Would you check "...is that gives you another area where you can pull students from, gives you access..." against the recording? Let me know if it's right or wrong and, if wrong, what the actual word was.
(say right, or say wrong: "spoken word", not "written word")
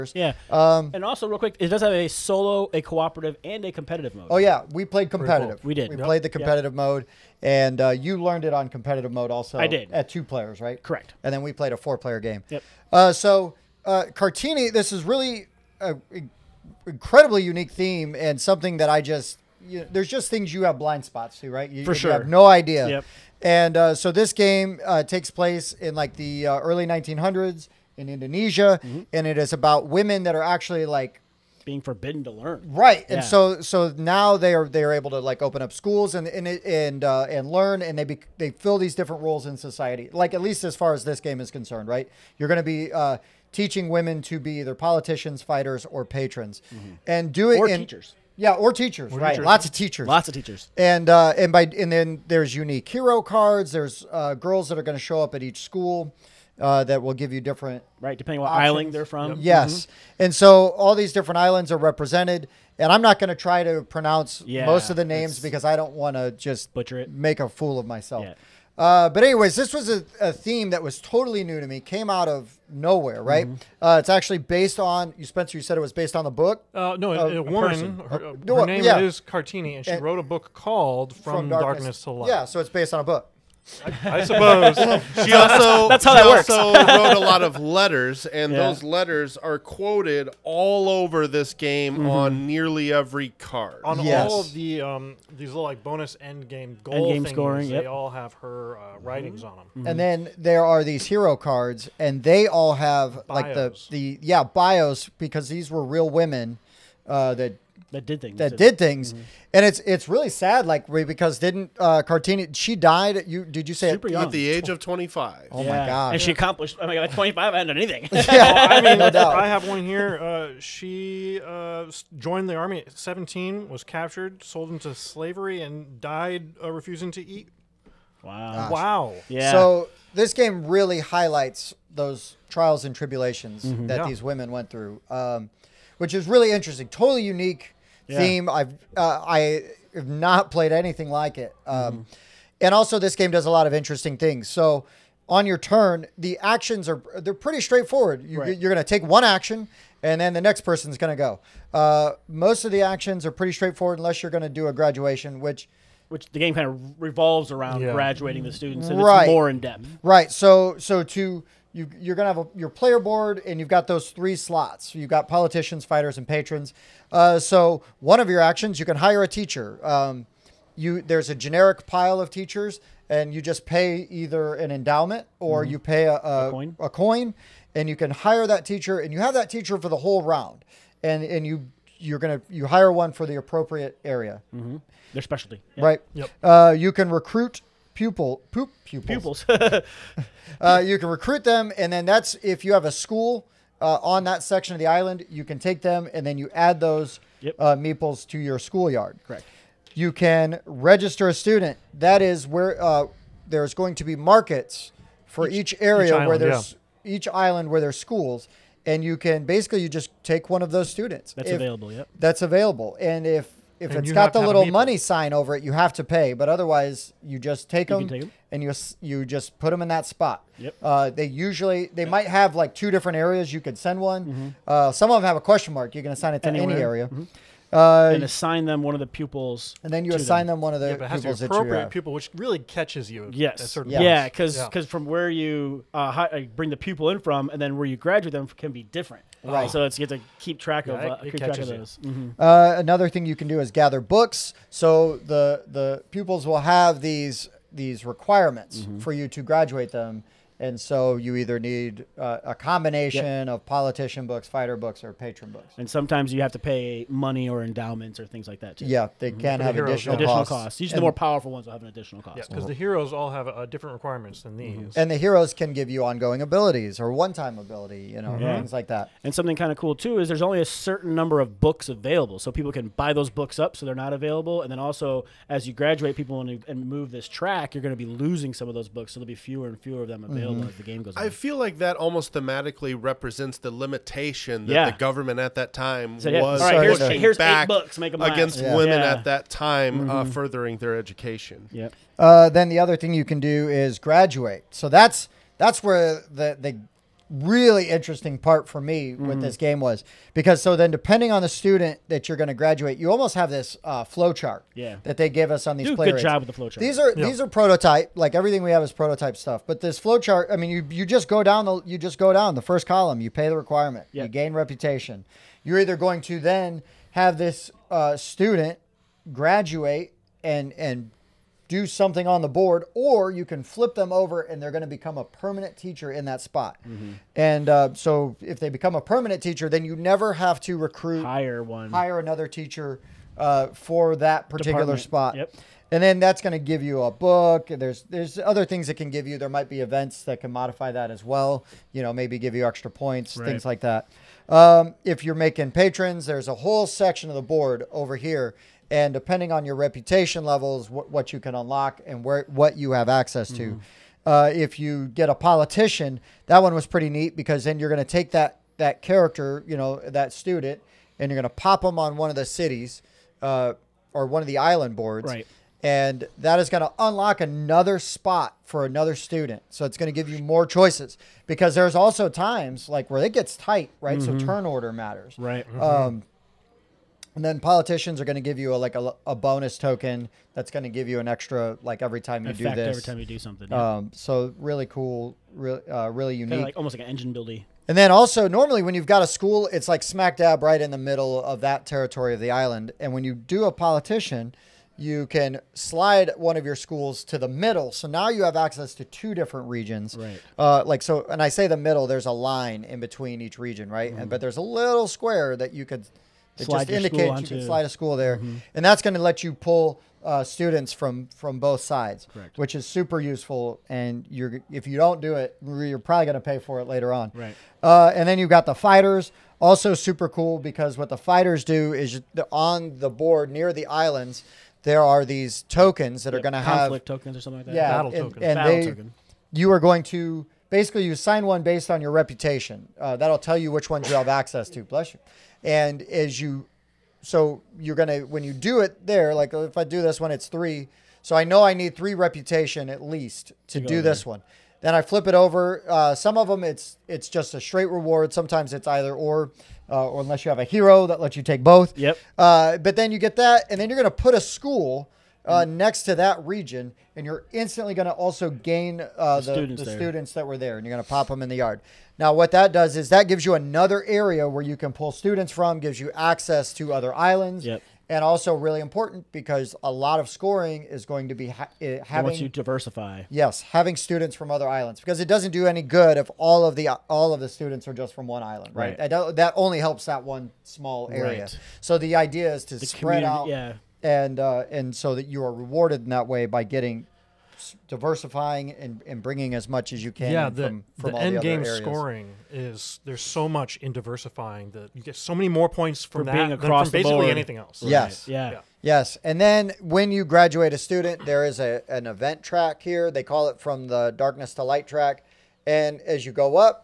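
right.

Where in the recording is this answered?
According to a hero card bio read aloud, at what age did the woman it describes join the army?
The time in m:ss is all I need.
2:02.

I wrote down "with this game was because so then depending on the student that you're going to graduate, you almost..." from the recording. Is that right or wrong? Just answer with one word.
right.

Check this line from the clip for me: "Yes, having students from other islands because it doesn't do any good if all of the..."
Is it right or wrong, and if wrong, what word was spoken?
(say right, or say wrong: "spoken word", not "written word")
right.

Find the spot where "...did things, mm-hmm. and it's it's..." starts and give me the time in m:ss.
1:48.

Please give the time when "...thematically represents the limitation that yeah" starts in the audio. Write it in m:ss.
4:42.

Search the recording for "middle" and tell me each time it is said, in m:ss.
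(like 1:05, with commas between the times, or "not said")
6:30, 6:37, 6:41.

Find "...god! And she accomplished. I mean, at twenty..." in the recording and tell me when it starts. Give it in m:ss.
1:55.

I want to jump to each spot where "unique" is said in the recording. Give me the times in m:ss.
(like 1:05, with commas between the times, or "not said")
0:17, 0:52, 2:17, 6:26.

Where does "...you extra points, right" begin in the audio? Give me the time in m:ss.
5:42.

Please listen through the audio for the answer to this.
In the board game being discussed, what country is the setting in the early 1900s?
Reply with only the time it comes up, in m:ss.
0:28.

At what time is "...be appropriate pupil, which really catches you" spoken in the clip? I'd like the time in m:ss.
3:51.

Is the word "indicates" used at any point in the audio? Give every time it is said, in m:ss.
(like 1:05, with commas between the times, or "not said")
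6:46.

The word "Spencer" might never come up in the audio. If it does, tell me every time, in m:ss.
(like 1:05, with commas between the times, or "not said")
1:15.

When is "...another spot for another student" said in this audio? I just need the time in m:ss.
6:07.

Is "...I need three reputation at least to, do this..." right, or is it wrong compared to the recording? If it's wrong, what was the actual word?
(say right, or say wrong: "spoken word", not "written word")
right.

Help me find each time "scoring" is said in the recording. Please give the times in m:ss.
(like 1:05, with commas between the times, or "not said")
1:37, 7:50, 8:11.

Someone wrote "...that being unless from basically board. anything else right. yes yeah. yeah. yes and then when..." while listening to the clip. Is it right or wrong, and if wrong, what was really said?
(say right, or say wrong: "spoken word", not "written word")
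wrong: "across", not "unless".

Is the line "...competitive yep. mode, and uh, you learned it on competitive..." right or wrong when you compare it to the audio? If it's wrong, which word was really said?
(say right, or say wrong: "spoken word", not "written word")
right.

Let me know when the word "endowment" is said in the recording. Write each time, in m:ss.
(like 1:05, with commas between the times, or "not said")
2:54, 4:17.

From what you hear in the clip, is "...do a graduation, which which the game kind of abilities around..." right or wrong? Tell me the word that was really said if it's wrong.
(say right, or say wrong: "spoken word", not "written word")
wrong: "revolves", not "abilities".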